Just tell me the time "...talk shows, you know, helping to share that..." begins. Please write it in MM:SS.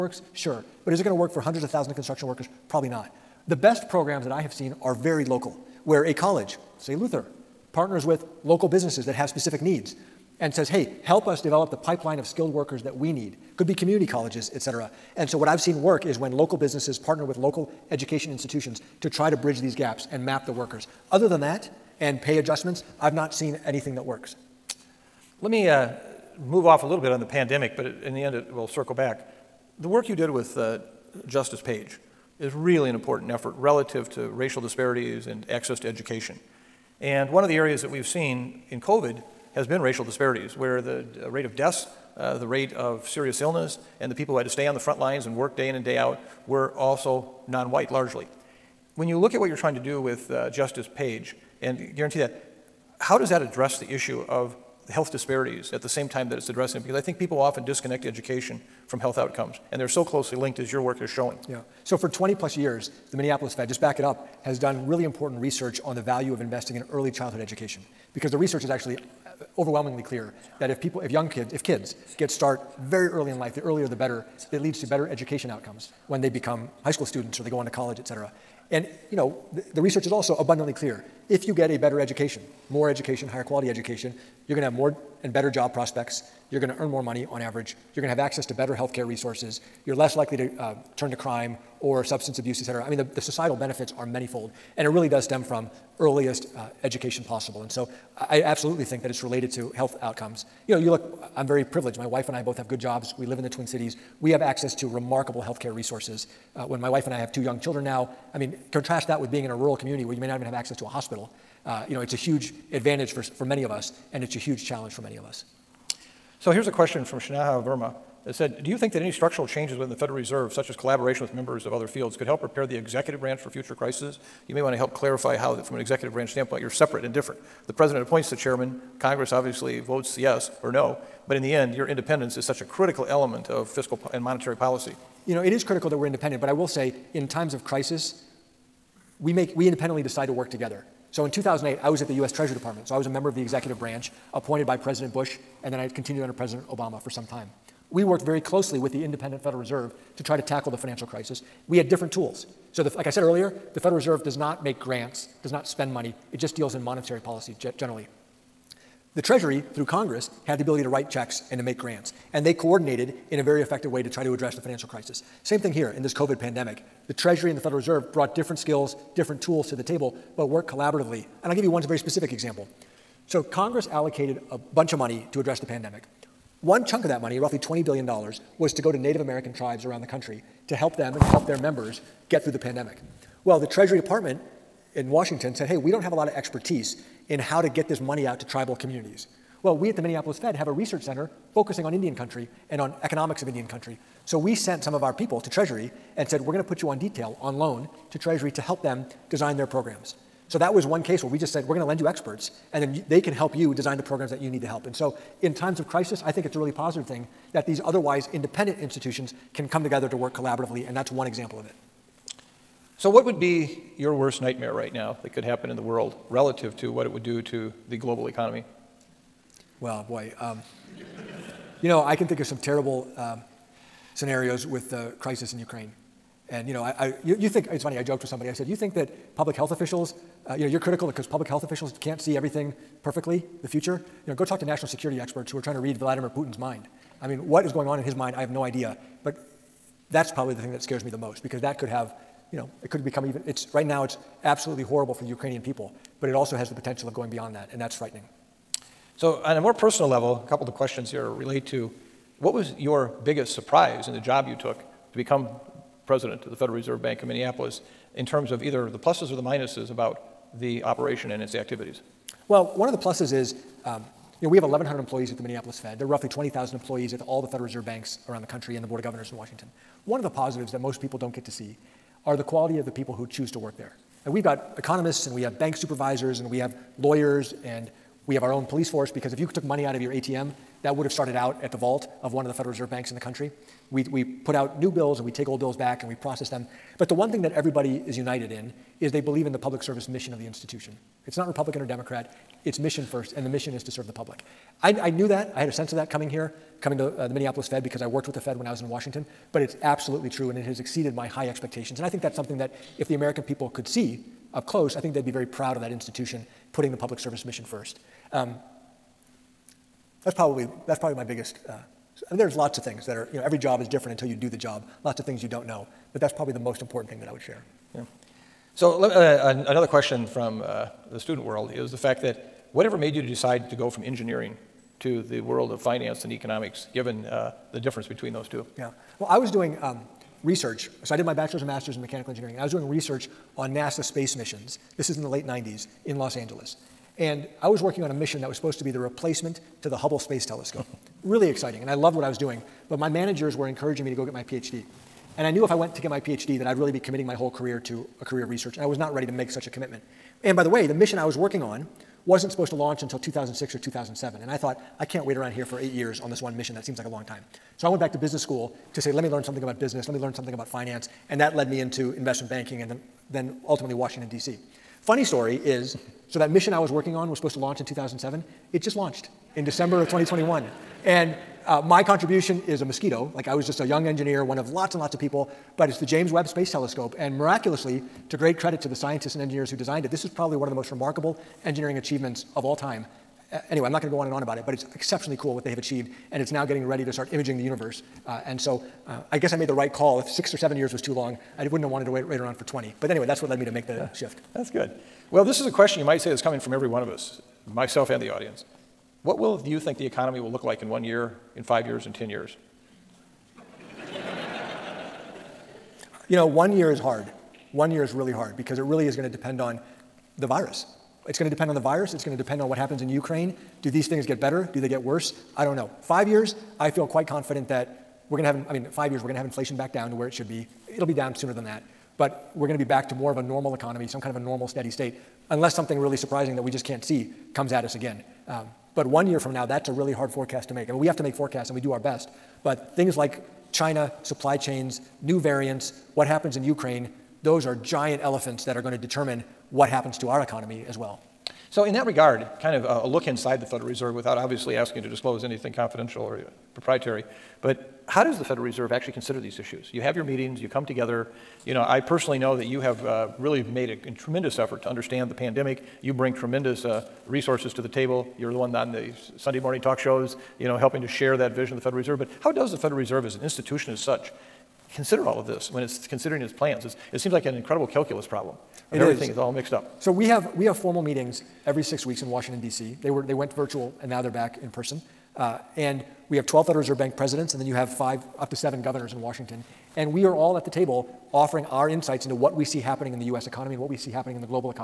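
07:39.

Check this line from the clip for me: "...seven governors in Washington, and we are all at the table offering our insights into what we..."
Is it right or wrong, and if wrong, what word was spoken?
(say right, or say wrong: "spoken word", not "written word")
right.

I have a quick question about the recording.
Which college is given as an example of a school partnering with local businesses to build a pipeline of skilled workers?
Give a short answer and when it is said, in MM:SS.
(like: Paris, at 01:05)
Luther, at 00:06.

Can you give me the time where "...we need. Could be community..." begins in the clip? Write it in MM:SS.
00:12.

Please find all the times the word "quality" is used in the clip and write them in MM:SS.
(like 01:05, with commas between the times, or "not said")
01:23, 04:32.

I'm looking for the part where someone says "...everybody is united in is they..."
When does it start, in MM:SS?
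04:47.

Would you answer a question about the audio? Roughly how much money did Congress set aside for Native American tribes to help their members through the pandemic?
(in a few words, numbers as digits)
$20 billion.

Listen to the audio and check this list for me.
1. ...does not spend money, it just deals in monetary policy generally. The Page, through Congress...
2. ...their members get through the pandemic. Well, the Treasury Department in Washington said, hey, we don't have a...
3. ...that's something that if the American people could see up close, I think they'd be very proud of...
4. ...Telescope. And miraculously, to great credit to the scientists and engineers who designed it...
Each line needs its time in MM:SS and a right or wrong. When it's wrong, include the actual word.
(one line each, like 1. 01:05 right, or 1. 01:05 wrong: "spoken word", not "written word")
1. 02:35 wrong: "Treasury", not "Page"
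2. 03:01 right
3. 05:02 right
4. 06:16 right.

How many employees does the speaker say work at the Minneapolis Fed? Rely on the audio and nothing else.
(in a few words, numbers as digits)
1,100.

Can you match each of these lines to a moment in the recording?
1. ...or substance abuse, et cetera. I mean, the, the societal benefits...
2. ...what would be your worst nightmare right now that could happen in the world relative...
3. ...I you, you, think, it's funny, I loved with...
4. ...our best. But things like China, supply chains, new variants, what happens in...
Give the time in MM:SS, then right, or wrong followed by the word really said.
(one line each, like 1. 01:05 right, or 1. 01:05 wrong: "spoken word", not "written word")
1. 01:31 right
2. 03:33 right
3. 03:46 wrong: "joked", not "loved"
4. 07:11 right.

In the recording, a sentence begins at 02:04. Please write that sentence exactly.
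You may want to help clarify how, from an executive branch standpoint, you're separate and different.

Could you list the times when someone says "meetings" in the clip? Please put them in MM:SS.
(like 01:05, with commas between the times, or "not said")
07:30, 07:51.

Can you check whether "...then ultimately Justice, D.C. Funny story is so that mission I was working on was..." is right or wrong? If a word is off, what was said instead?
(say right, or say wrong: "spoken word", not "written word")
wrong: "Washington", not "Justice".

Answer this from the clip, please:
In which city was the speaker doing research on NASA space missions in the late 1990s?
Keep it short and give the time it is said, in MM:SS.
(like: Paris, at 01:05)
Los Angeles, at 05:36.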